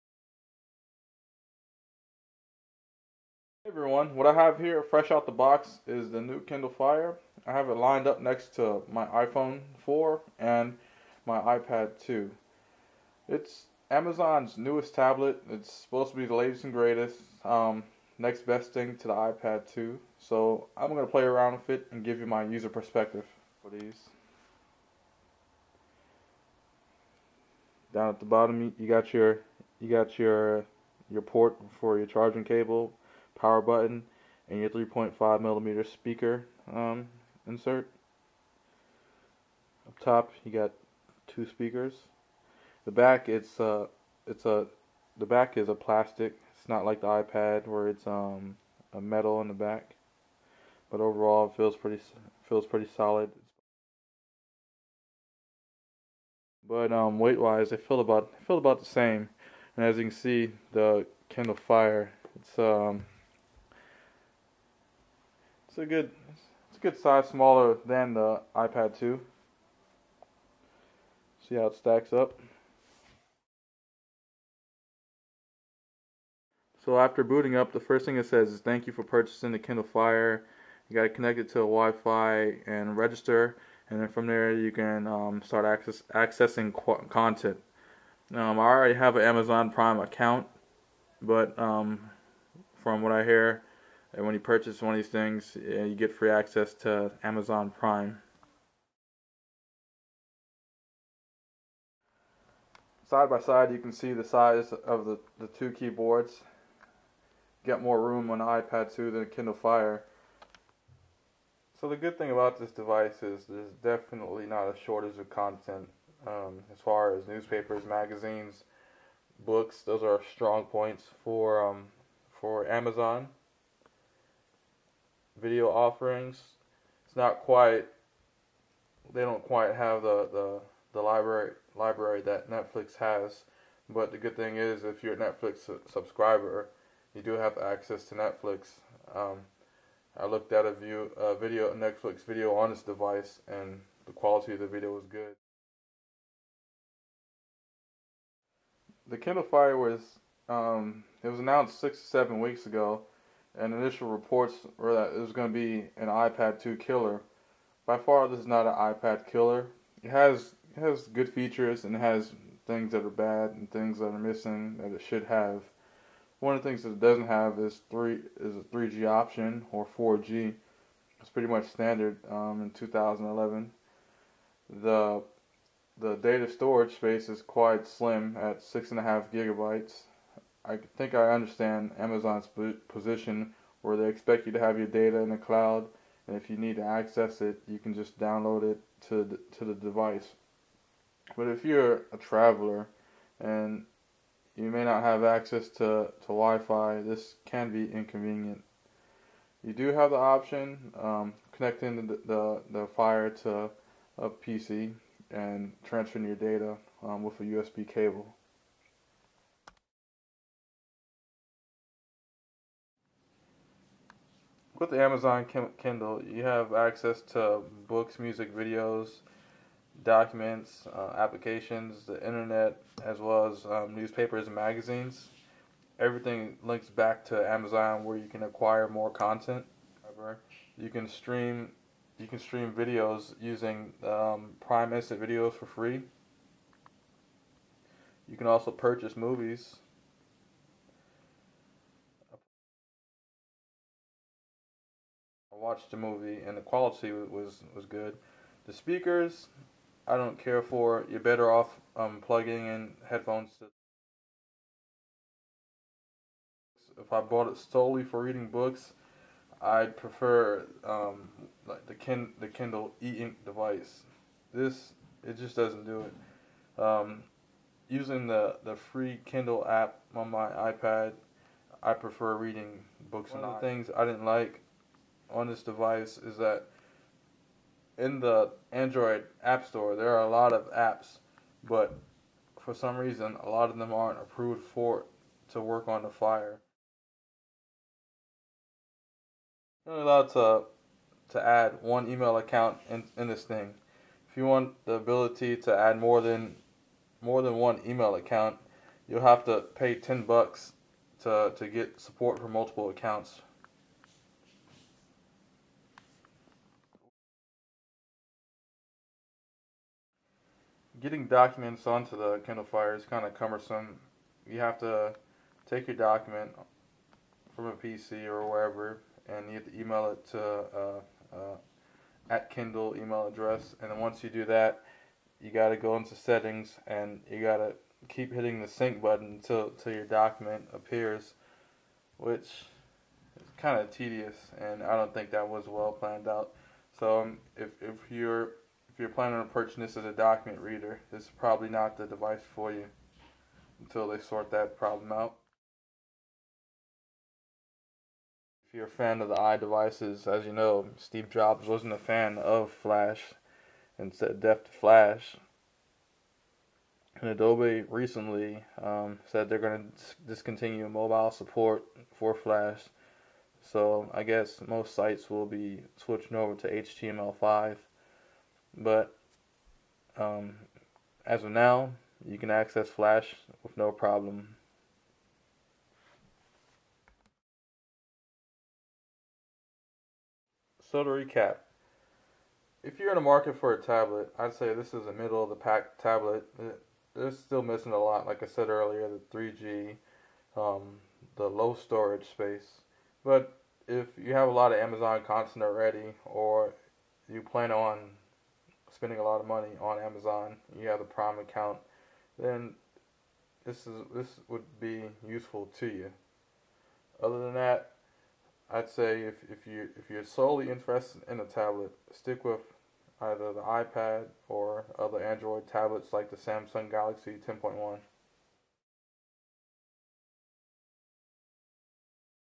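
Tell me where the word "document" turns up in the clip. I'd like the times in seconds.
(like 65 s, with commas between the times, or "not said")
220 s, 311 s, 315 s, 330 s, 340 s.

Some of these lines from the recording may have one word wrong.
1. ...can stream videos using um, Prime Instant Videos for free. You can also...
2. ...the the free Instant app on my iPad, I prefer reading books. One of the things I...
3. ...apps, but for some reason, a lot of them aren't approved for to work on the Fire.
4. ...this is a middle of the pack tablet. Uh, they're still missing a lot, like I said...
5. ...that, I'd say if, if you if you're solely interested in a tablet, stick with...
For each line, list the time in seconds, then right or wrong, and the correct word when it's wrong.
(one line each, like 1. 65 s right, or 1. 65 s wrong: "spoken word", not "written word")
1. 232 s right
2. 268 s wrong: "Kindle", not "Instant"
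3. 280 s right
4. 384 s right
5. 407 s right.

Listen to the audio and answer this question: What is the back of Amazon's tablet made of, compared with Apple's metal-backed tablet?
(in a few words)
plastic.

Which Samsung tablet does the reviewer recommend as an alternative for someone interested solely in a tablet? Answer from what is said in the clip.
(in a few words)
Samsung Galaxy 10.1.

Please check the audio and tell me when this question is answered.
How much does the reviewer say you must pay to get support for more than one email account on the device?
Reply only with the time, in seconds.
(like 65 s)
299 s.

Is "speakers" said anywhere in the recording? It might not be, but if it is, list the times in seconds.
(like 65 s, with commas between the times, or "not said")
35 s, 41 s, 248 s.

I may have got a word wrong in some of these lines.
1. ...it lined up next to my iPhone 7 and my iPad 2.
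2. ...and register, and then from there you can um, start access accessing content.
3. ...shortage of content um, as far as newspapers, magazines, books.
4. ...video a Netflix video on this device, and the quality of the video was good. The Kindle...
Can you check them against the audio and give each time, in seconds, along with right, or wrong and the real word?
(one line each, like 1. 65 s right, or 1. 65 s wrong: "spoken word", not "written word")
1. 7 s wrong: "4", not "7"
2. 82 s right
3. 114 s right
4. 141 s right.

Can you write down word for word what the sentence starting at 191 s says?
But if you're a traveler and you may not have access to, to Wi-Fi, this can be inconvenient.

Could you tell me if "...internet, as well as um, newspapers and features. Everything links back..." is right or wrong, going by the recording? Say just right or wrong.
wrong.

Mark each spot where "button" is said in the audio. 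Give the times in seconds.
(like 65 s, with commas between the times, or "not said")
33 s, 329 s.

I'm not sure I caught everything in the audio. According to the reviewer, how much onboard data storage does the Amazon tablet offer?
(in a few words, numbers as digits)
6.5 gigabytes.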